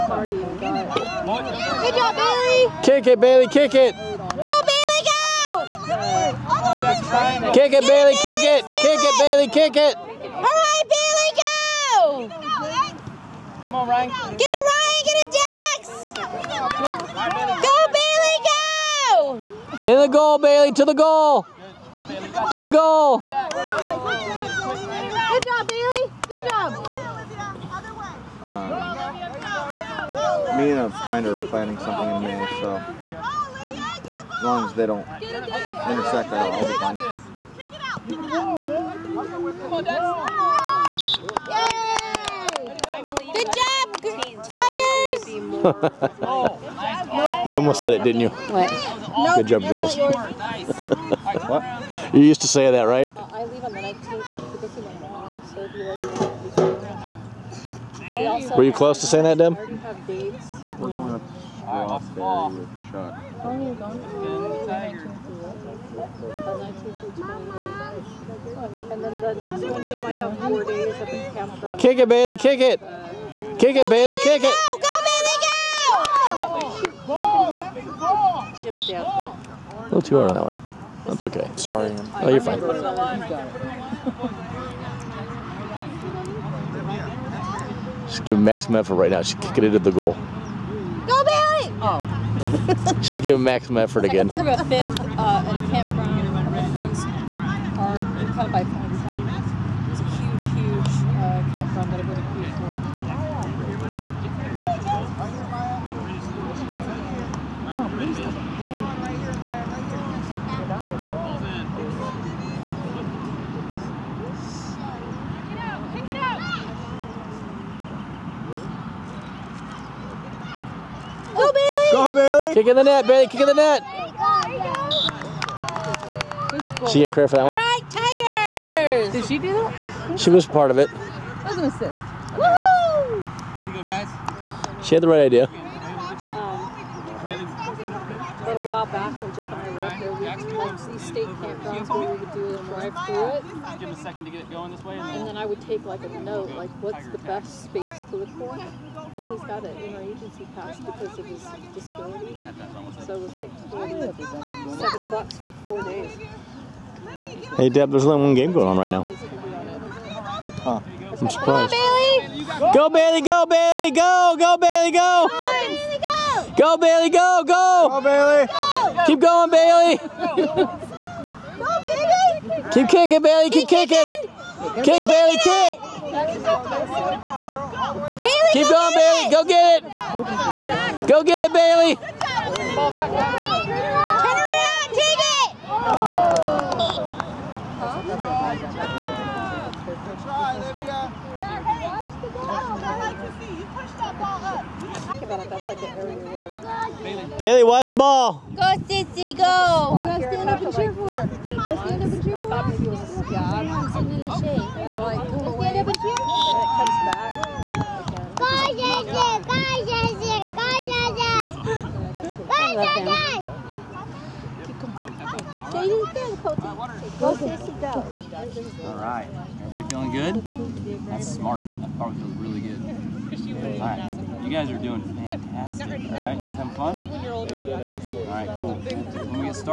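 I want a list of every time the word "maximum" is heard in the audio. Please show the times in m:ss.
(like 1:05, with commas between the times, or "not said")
1:28, 1:33.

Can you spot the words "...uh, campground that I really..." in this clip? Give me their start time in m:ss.
1:41.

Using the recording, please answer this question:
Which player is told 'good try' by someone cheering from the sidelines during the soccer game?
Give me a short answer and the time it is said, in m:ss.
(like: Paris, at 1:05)
Olivia, at 3:10.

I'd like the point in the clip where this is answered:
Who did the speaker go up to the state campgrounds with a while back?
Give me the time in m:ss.
2:19.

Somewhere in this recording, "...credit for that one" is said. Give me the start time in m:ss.
2:07.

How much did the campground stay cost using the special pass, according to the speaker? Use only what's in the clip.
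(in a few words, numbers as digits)
7 bucks.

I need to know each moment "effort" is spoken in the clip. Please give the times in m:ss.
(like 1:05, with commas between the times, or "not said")
1:28, 1:33.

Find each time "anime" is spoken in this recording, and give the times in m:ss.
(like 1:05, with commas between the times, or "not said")
not said.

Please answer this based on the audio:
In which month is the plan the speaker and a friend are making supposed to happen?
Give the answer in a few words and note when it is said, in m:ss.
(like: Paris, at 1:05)
May, at 0:32.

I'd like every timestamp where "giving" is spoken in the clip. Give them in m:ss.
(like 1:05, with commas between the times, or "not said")
1:28, 1:33.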